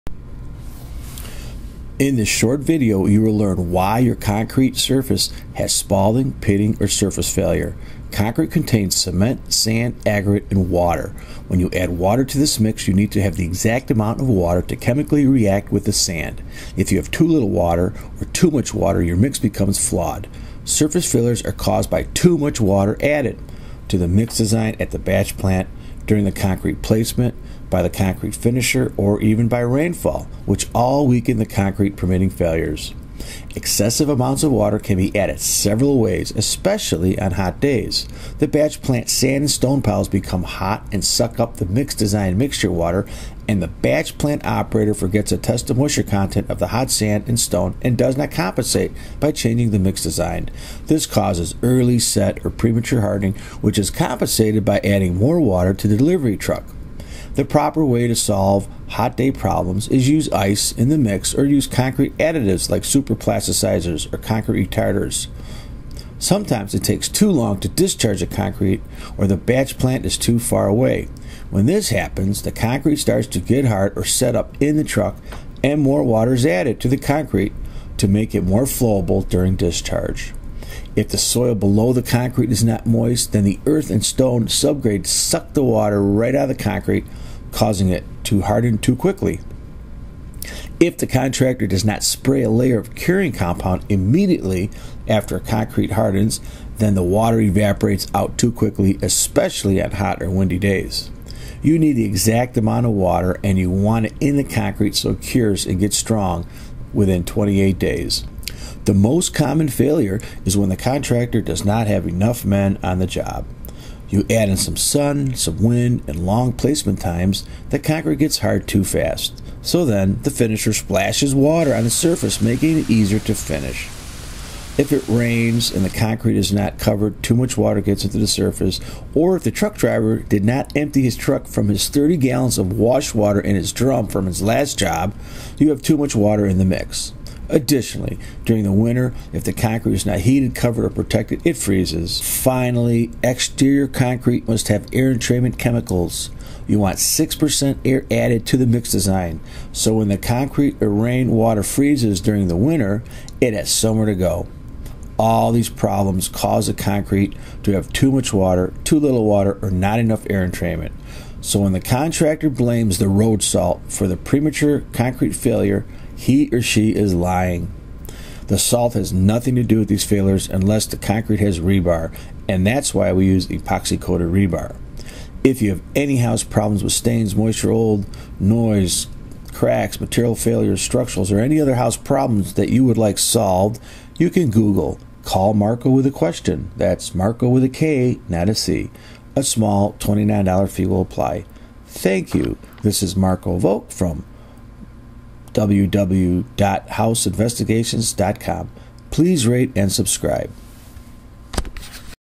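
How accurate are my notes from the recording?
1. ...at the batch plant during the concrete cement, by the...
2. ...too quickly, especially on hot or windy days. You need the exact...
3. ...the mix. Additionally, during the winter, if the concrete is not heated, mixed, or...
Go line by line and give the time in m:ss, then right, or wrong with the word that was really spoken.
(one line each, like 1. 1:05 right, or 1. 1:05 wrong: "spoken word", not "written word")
1. 0:24 wrong: "placement", not "cement"
2. 1:38 right
3. 2:16 wrong: "covered", not "mixed".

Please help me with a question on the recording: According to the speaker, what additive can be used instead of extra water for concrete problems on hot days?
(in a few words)
superplasticizers.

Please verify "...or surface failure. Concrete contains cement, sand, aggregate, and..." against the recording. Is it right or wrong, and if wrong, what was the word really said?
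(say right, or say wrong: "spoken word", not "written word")
right.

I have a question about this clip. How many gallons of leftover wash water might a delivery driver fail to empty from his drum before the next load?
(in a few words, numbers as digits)
30.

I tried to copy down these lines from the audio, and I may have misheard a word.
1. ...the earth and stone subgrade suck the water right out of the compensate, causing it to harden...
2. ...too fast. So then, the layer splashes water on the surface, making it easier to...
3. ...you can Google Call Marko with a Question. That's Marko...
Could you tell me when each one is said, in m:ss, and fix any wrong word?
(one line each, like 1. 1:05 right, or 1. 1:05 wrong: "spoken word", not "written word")
1. 1:23 wrong: "concrete", not "compensate"
2. 1:58 wrong: "finisher", not "layer"
3. 3:04 right.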